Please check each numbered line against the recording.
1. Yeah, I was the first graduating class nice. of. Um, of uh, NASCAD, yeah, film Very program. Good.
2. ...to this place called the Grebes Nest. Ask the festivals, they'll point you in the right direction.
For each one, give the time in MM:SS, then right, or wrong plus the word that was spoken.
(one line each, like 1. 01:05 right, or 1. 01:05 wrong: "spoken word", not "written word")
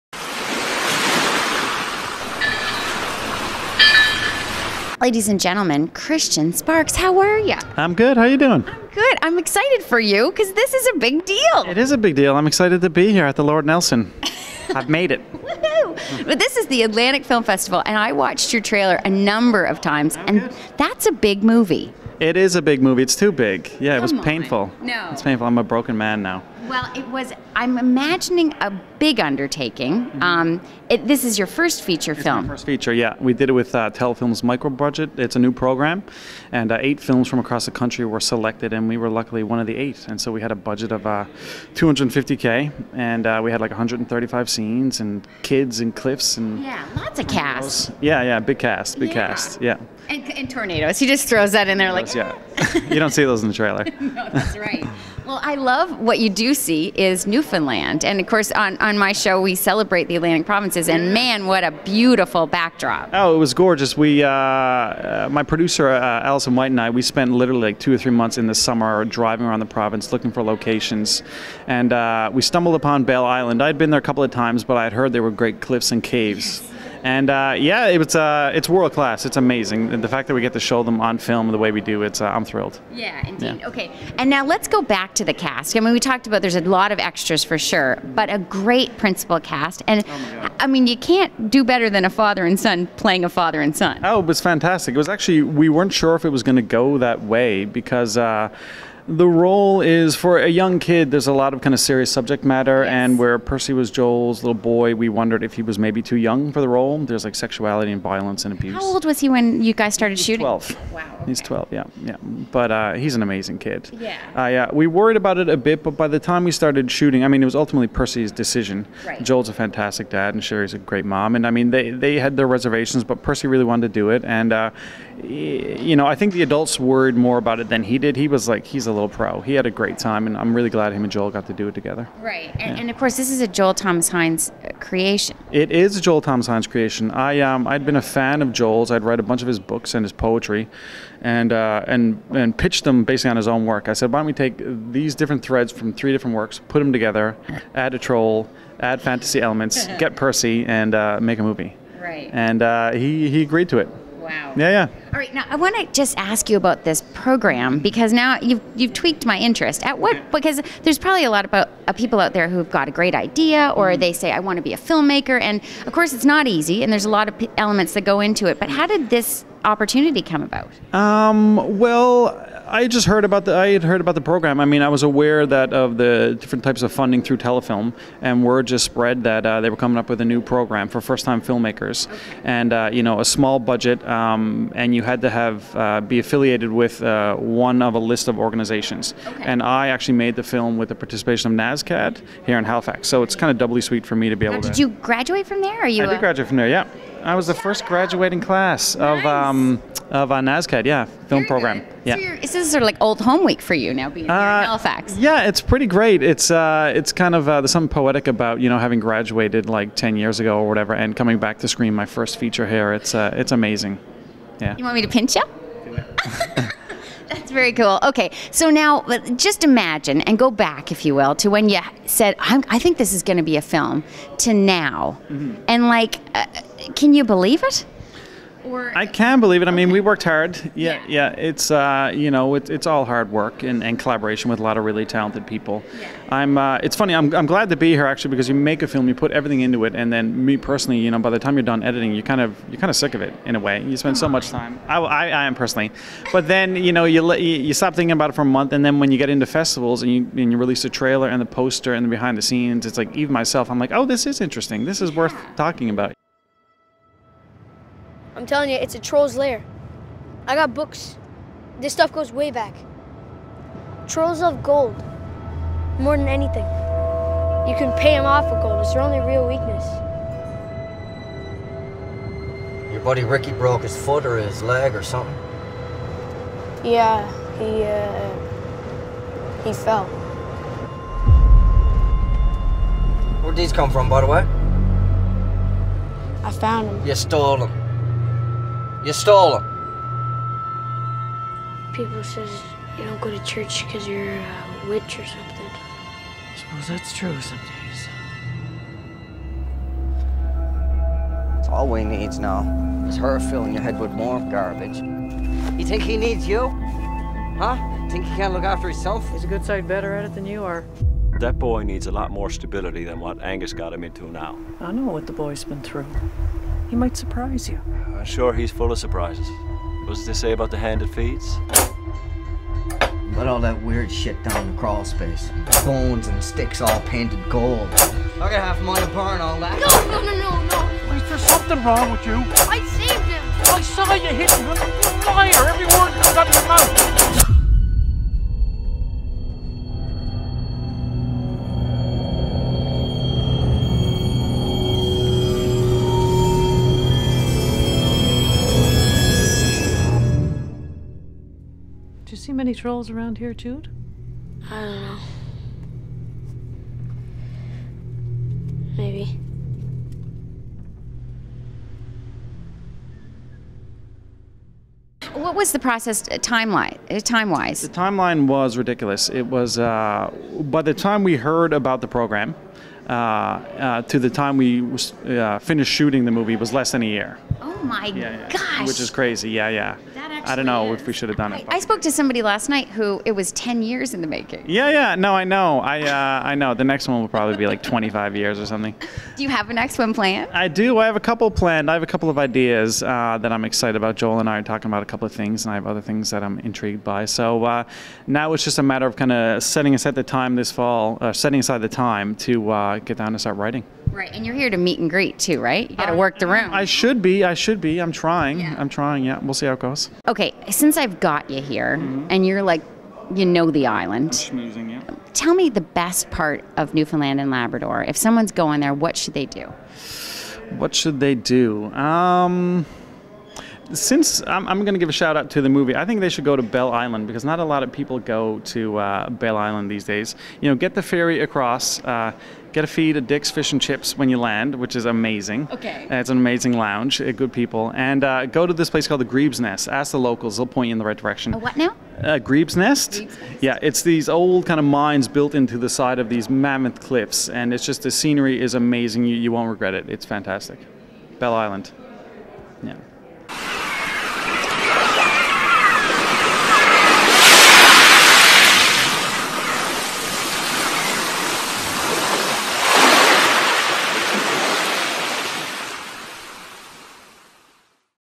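1. 03:16 right
2. 07:18 wrong: "locals", not "festivals".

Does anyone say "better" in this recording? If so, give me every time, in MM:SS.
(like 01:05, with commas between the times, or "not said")
01:31, 05:09.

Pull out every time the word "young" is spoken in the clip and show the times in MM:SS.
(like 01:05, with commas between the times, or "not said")
01:40, 01:46.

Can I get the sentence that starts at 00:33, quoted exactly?
We did it with uh, Telefilm's micro budget.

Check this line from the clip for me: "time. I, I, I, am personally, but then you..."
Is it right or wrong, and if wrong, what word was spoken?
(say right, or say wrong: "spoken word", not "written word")
right.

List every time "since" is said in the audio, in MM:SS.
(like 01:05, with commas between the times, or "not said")
06:50, 07:03.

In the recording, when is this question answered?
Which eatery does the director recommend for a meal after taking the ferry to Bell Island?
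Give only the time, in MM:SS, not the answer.
07:13.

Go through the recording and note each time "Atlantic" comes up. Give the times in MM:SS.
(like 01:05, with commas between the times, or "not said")
00:16, 01:00.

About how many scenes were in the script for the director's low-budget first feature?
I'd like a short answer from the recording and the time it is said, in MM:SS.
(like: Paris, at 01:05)
135, at 00:43.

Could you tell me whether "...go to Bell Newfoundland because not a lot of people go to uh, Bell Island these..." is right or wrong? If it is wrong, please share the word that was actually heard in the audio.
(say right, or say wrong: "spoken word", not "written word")
wrong: "Island", not "Newfoundland".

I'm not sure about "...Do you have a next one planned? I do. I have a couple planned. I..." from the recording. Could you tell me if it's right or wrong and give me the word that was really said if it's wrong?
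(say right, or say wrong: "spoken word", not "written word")
right.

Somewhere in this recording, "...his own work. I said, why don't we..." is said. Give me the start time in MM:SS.
02:23.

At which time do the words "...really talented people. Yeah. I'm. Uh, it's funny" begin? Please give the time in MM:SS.
03:54.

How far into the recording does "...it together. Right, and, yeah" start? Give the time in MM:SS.
02:11.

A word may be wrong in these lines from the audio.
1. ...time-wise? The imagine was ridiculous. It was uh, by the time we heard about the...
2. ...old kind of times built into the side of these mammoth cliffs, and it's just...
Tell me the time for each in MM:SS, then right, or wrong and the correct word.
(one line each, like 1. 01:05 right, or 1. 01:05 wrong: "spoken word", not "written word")
1. 06:07 wrong: "timeline", not "imagine"
2. 07:24 wrong: "mines", not "times".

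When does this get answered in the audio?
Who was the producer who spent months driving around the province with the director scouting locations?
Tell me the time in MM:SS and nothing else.
01:06.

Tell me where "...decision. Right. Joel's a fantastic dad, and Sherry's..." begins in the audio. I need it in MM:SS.
01:58.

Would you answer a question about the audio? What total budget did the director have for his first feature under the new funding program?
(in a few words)
250k.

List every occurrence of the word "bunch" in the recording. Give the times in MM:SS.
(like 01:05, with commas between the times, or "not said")
02:19.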